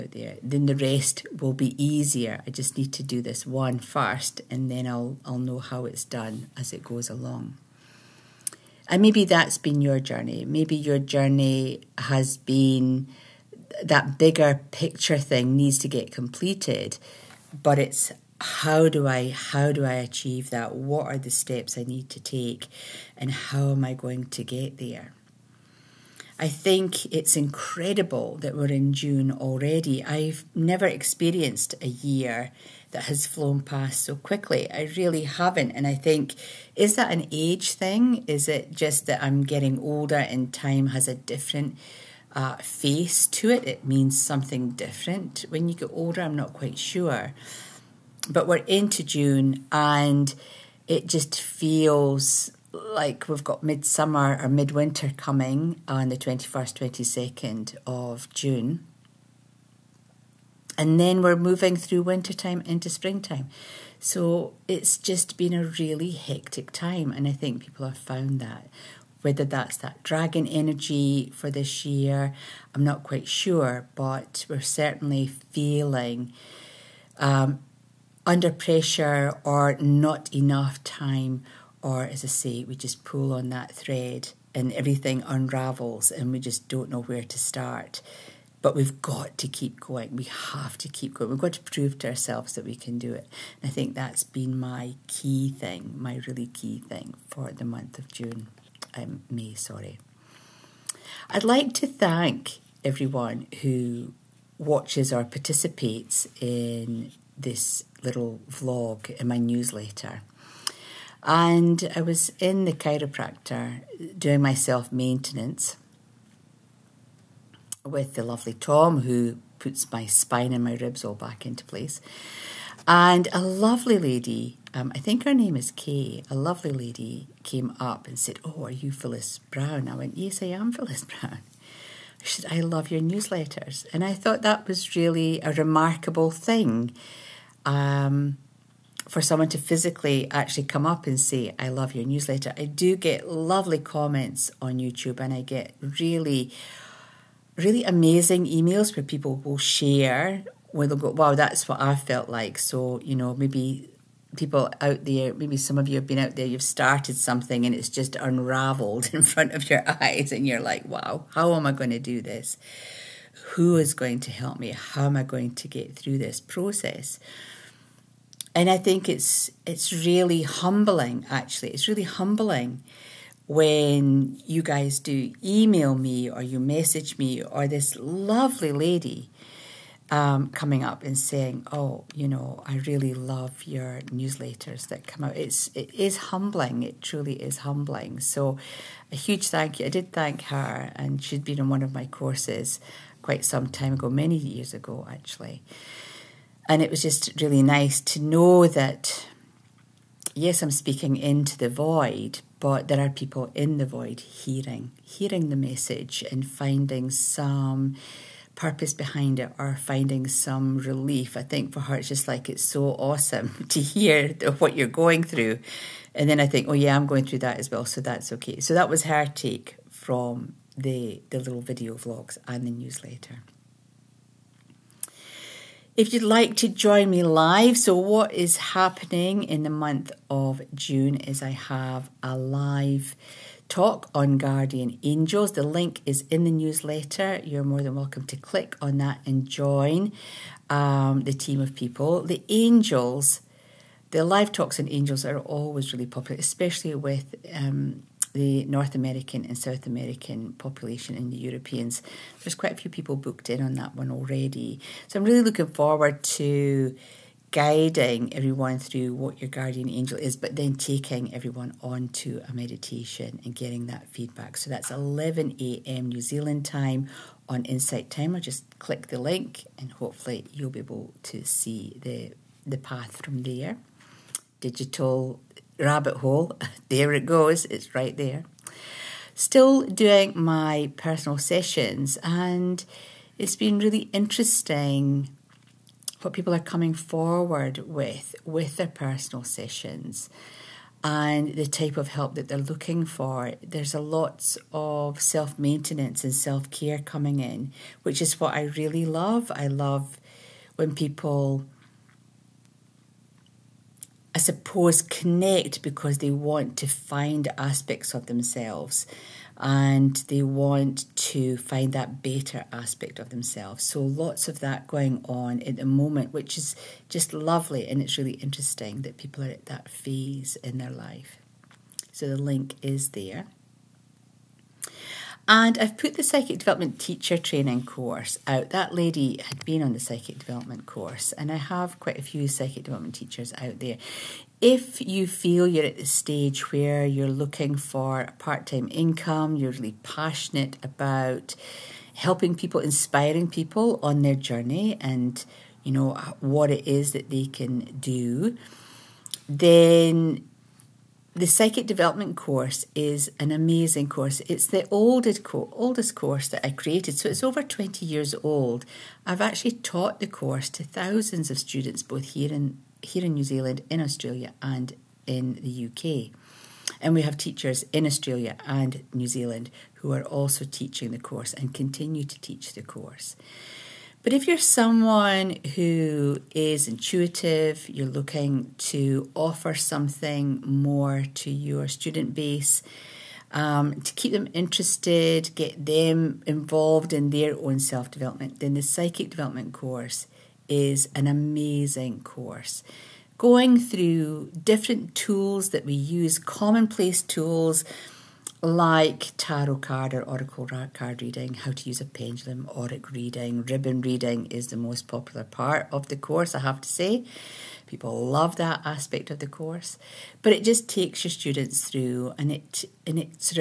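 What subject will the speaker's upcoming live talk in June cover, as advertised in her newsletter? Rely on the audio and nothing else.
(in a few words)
Guardian angels.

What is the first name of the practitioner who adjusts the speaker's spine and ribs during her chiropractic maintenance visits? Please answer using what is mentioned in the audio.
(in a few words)
Tom.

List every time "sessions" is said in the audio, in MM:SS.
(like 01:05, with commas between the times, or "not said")
04:41, 04:49.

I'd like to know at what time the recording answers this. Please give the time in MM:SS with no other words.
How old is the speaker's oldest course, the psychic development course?
05:57.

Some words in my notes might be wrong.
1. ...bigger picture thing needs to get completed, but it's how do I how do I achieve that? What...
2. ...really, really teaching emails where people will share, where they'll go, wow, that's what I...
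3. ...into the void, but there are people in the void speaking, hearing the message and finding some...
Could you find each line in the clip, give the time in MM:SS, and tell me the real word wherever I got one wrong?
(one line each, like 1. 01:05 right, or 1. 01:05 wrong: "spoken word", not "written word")
1. 00:14 right
2. 02:25 wrong: "amazing", not "teaching"
3. 03:21 wrong: "hearing", not "speaking".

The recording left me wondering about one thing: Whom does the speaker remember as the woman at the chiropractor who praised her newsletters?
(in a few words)
Kay.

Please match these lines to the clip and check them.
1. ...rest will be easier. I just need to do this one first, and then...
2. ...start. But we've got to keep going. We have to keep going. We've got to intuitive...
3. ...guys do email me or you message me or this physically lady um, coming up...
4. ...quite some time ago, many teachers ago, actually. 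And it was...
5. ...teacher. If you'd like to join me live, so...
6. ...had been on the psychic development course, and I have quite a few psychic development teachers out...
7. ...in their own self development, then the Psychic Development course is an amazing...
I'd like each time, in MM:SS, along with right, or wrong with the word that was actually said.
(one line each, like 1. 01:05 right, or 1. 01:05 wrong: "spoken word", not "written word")
1. 00:00 right
2. 01:27 wrong: "prove", not "intuitive"
3. 02:54 wrong: "lovely", not "physically"
4. 03:13 wrong: "years", not "teachers"
5. 03:42 wrong: "newsletter", not "teacher"
6. 05:29 right
7. 06:27 right.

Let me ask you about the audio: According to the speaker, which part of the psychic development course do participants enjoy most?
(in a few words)
Ribbon reading.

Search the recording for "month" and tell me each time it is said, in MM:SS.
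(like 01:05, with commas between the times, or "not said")
01:37, 03:49.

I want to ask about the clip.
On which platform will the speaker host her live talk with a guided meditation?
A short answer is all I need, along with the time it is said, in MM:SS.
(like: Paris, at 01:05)
Insight Timer, at 04:27.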